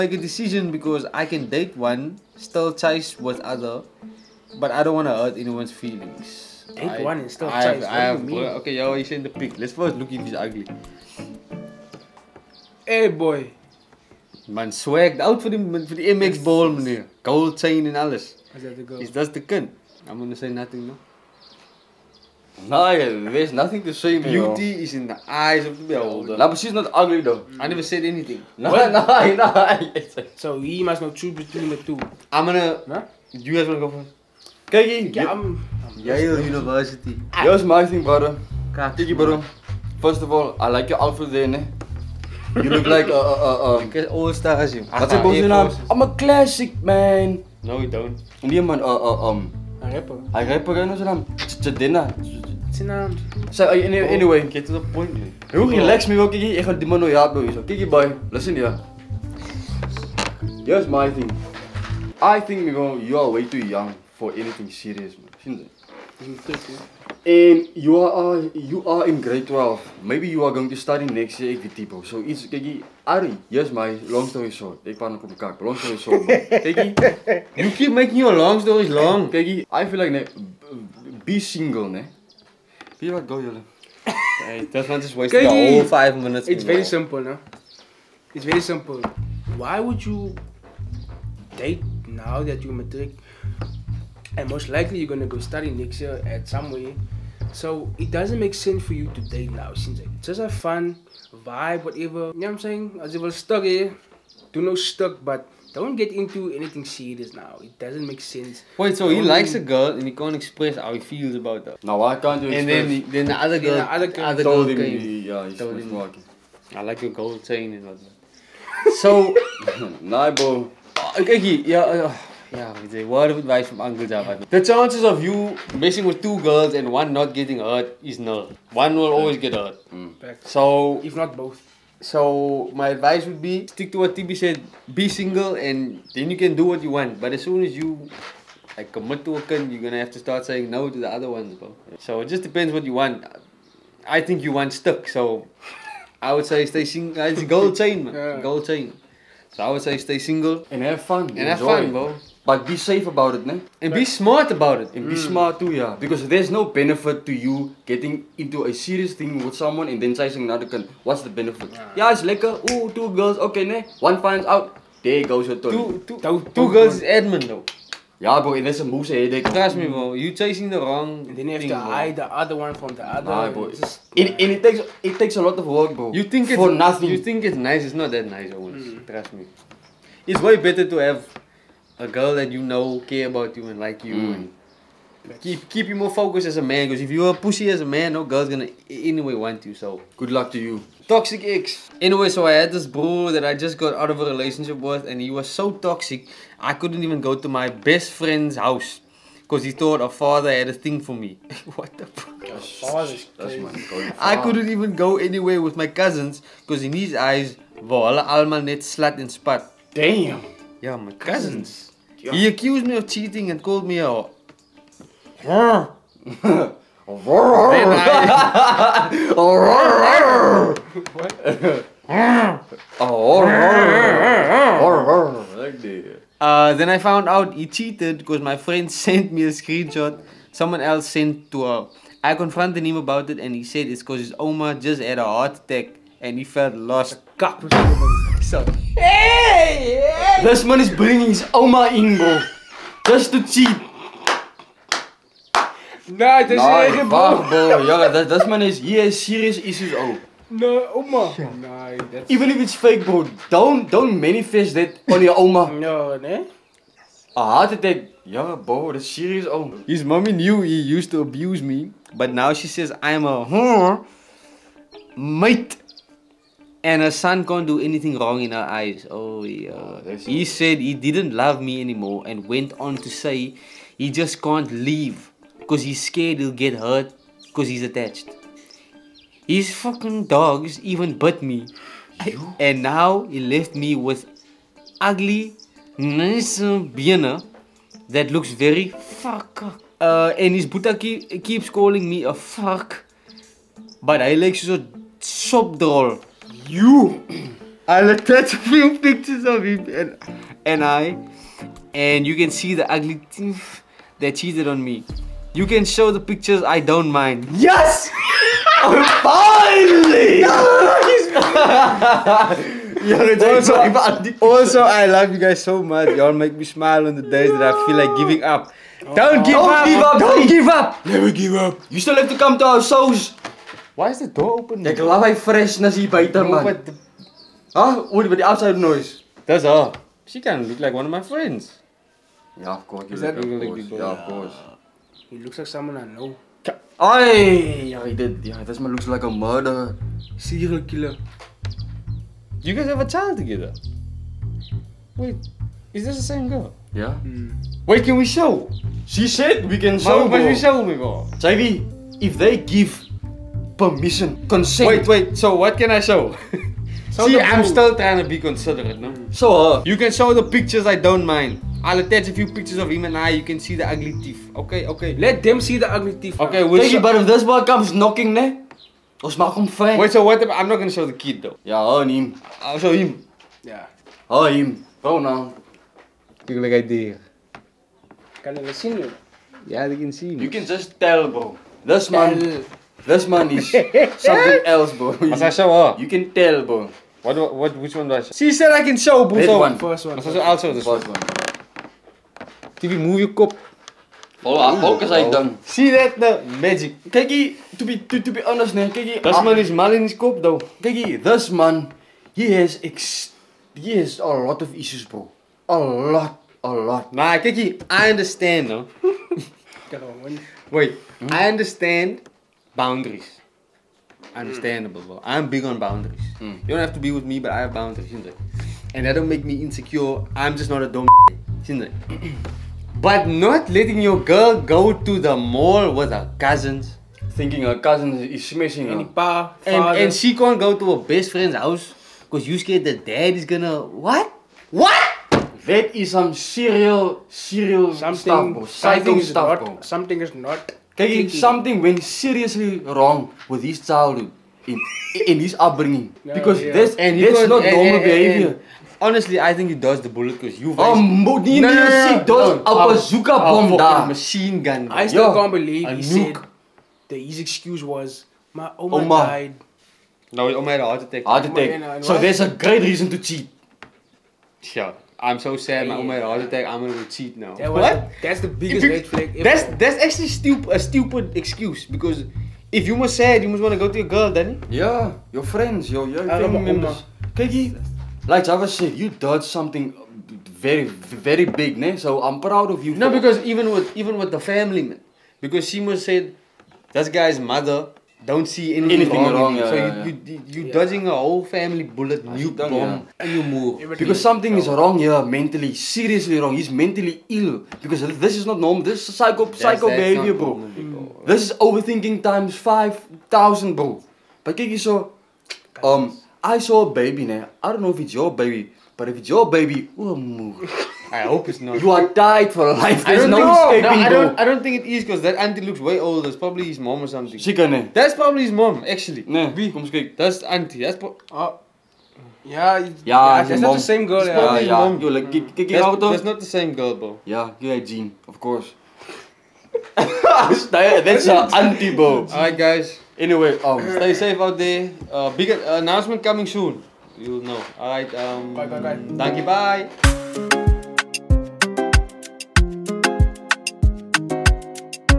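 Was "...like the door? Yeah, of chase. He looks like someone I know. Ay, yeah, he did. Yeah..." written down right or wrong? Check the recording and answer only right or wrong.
wrong.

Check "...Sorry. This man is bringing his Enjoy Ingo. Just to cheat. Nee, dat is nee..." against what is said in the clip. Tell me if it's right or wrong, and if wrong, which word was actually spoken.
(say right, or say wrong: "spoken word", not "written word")
wrong: "Oma", not "Enjoy".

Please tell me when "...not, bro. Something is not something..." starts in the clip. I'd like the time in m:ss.
7:19.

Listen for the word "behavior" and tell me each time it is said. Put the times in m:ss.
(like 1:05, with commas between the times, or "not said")
7:28, 8:19.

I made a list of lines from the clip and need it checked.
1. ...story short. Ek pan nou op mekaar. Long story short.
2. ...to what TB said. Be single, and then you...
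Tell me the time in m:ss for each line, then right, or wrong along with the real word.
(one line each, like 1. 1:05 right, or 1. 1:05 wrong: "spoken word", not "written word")
1. 1:14 right
2. 2:13 right.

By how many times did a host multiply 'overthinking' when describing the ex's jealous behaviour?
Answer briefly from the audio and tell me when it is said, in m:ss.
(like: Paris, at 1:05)
5000, at 8:22.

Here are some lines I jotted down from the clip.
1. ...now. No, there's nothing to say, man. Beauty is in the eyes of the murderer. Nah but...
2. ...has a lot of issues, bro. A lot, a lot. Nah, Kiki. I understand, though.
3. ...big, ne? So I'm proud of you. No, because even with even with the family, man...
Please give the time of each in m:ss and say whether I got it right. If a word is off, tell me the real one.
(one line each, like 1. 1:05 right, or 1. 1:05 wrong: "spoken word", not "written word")
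1. 0:20 wrong: "beholder", not "murderer"
2. 6:43 right
3. 8:01 right.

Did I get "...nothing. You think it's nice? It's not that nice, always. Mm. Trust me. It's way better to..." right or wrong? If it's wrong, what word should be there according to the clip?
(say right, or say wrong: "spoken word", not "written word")
right.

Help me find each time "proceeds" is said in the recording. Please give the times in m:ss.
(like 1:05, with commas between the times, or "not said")
not said.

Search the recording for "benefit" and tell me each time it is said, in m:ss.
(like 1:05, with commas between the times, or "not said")
2:36, 2:41.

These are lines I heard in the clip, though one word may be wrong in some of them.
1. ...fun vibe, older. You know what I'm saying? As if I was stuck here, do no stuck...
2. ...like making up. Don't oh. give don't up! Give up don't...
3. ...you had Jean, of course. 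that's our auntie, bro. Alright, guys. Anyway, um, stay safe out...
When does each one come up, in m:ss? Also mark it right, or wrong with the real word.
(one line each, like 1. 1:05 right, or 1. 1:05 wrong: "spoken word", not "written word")
1. 1:40 wrong: "whatever", not "older"
2. 5:17 wrong: "giving", not "making"
3. 8:47 right.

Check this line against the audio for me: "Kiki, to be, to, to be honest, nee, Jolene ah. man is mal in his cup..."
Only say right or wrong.
wrong.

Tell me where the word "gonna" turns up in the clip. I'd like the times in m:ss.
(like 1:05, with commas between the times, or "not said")
0:32, 1:35, 2:19, 3:08, 6:10, 7:13, 7:46.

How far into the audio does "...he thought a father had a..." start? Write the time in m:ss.
3:19.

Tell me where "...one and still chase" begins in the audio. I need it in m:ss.
0:07.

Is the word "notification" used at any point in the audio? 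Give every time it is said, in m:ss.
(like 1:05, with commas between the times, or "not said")
not said.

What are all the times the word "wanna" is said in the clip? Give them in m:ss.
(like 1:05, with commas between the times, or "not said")
0:33, 7:53.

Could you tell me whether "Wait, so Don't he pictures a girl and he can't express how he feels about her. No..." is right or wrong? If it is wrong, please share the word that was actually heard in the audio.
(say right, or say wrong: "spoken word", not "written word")
wrong: "likes", not "pictures".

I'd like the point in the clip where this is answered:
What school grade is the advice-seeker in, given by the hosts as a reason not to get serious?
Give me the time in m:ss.
1:09.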